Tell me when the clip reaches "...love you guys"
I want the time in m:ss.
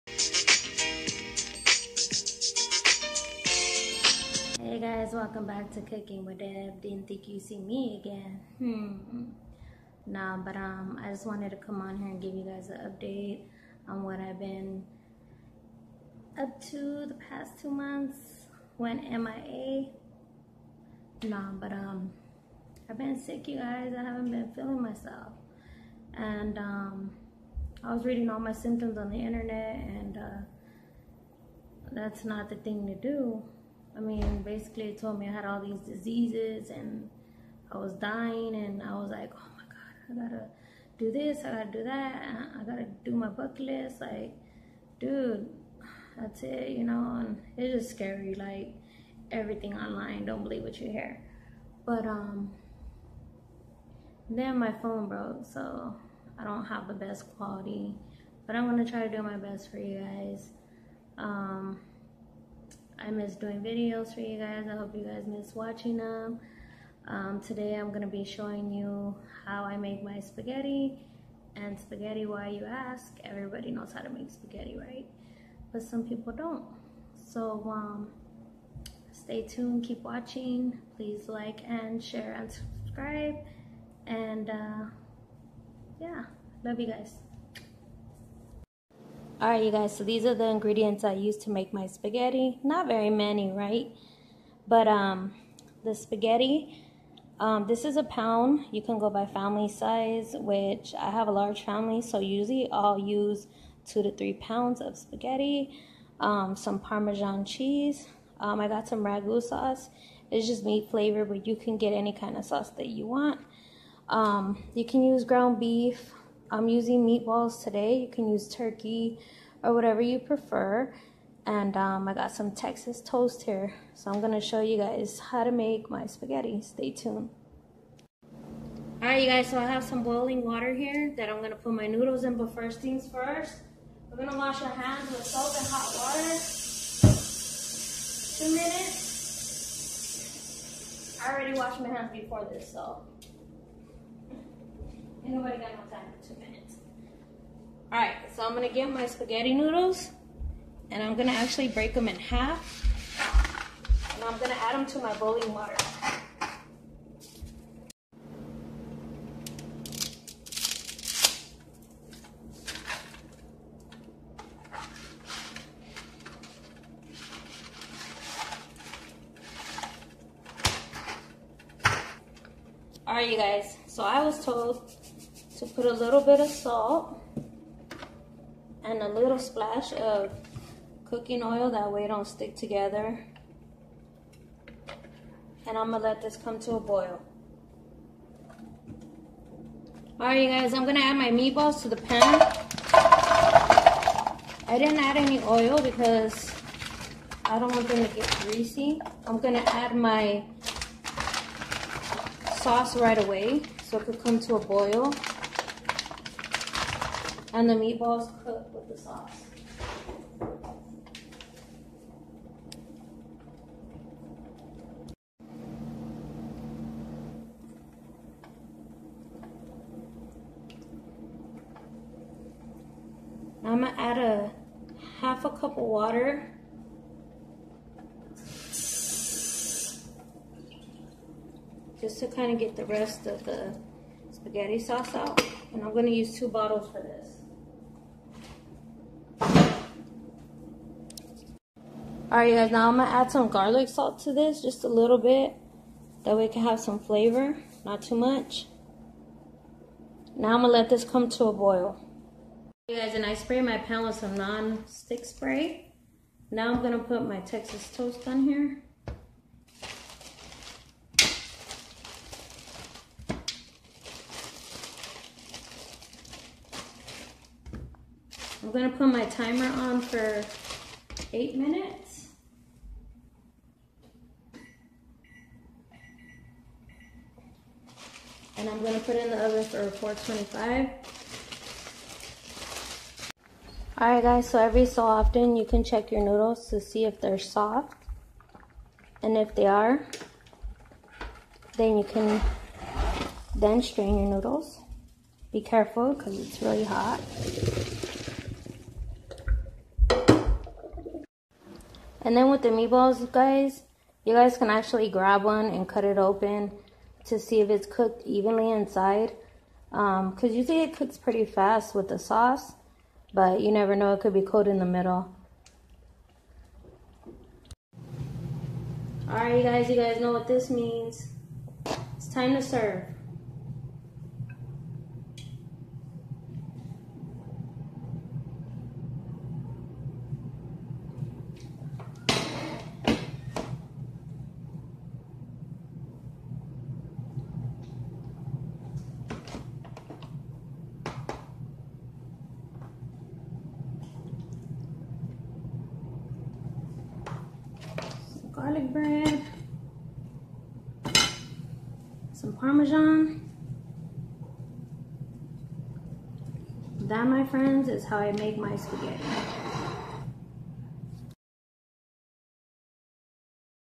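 1:26.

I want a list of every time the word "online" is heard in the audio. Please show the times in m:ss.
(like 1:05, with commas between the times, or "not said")
0:49.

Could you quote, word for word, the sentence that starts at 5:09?
Because um, usually it cooks pretty fast with the sauce, but you never know, it could be cold in the middle.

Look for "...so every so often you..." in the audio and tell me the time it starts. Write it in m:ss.
4:44.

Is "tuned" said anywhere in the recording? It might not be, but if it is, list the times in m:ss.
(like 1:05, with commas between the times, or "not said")
1:19, 2:06.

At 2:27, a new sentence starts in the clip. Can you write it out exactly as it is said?
Alright, so I'm going to get my spaghetti noodles.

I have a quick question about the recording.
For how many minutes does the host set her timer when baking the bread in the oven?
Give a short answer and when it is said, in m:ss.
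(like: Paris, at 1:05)
8, at 4:31.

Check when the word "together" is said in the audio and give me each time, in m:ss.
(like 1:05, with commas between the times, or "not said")
3:02.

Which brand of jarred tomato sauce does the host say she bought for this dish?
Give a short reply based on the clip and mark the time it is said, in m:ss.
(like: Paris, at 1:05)
Ragu, at 1:49.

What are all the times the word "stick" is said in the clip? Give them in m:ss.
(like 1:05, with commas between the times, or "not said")
3:02, 4:14.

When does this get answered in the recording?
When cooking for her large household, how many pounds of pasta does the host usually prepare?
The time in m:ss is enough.
1:43.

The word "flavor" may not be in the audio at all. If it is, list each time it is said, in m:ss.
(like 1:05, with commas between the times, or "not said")
1:50, 4:06.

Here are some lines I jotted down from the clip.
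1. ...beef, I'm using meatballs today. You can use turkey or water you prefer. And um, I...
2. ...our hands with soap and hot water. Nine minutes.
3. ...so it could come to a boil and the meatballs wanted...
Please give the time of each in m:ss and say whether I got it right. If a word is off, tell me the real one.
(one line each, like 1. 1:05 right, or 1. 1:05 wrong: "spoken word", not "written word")
1. 1:55 wrong: "whatever", not "water"
2. 2:14 wrong: "Two", not "Nine"
3. 3:23 wrong: "cooked", not "wanted".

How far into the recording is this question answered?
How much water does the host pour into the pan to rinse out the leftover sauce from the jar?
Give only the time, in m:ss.
3:44.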